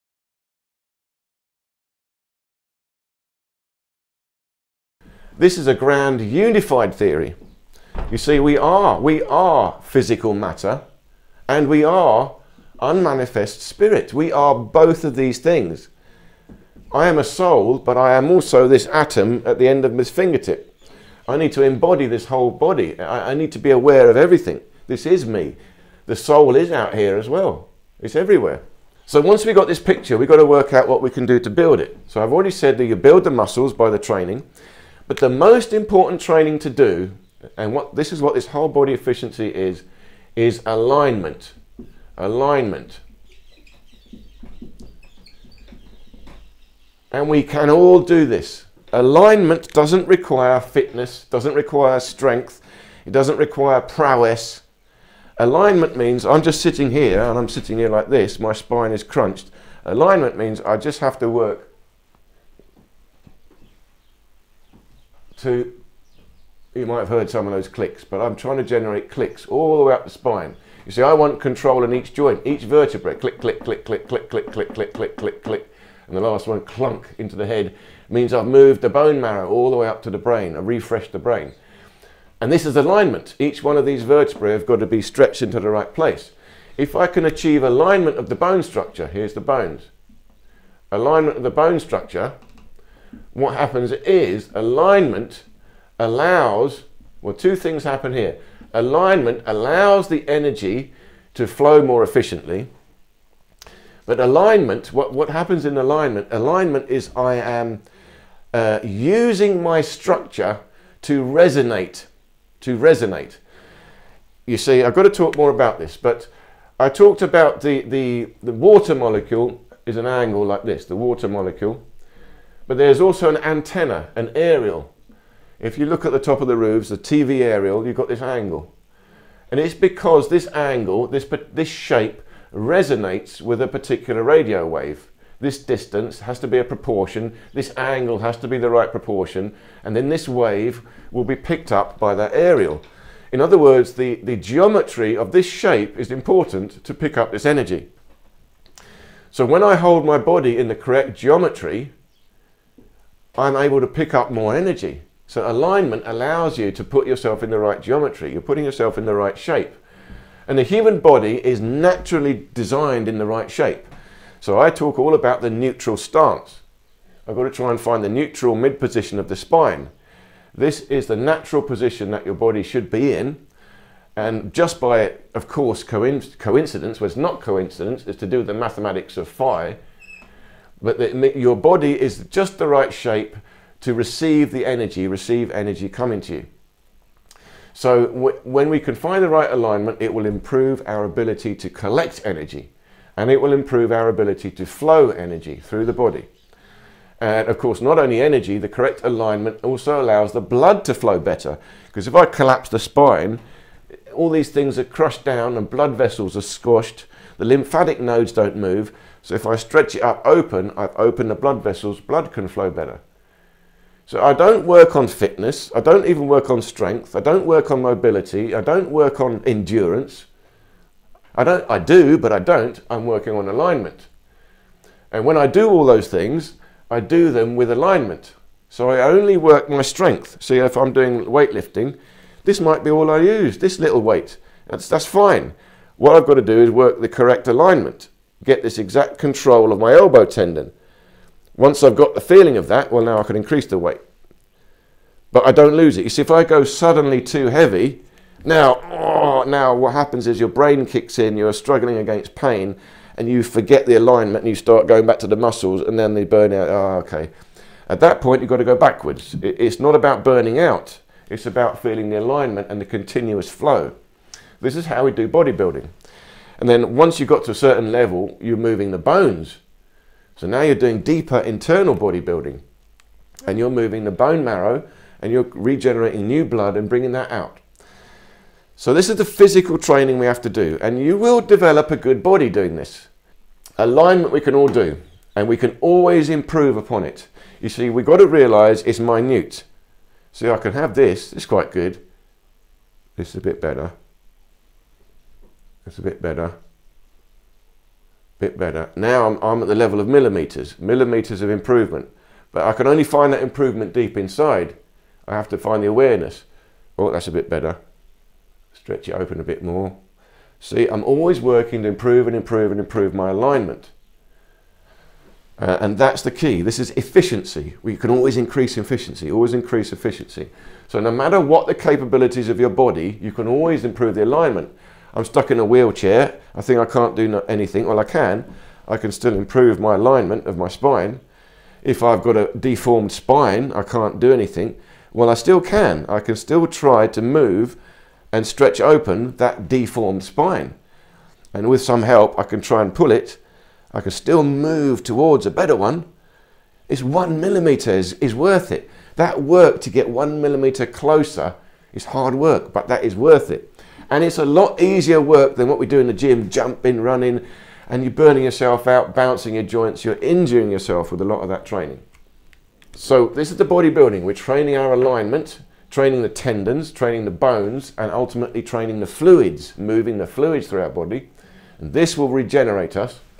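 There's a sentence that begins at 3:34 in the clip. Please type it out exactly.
So I don't work on fitness, I don't even work on strength, I don't work on mobility, I don't work on endurance.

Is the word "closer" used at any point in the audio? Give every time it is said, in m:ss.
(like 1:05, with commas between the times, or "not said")
5:50.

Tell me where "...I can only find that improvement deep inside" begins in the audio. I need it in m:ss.
5:02.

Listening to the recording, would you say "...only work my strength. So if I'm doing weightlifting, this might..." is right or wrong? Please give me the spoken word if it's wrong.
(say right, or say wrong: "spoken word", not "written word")
right.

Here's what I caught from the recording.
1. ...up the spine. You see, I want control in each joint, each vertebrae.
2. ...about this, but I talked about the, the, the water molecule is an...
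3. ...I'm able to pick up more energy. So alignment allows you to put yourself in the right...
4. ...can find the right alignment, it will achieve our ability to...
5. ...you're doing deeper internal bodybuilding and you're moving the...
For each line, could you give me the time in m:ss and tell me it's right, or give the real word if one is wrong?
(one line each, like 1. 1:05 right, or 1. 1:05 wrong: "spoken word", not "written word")
1. 1:09 right
2. 1:55 right
3. 2:33 right
4. 3:08 wrong: "improve", not "achieve"
5. 4:30 right.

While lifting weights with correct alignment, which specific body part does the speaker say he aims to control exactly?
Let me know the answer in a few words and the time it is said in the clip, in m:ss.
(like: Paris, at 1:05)
Elbow tendon, at 3:59.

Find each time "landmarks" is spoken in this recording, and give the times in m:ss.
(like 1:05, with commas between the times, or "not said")
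not said.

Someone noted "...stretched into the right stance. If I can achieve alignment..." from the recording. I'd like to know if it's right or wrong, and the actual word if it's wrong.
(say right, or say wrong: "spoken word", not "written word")
wrong: "place", not "stance".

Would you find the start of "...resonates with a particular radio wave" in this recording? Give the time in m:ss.
2:12.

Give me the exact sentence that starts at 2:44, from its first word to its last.
So I talk all about the neutral stance.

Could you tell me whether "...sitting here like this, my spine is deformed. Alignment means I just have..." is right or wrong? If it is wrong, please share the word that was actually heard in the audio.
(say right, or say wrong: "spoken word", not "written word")
wrong: "crunched", not "deformed".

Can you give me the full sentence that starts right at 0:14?
We are both of these things.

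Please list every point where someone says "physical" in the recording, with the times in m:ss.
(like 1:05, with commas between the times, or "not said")
0:09, 4:39.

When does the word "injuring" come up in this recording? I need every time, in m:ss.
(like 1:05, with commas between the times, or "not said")
6:00.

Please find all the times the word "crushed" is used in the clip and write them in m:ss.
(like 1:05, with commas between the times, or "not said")
3:24.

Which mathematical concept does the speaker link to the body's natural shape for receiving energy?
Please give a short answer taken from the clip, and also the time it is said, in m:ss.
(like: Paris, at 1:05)
Phi, at 2:59.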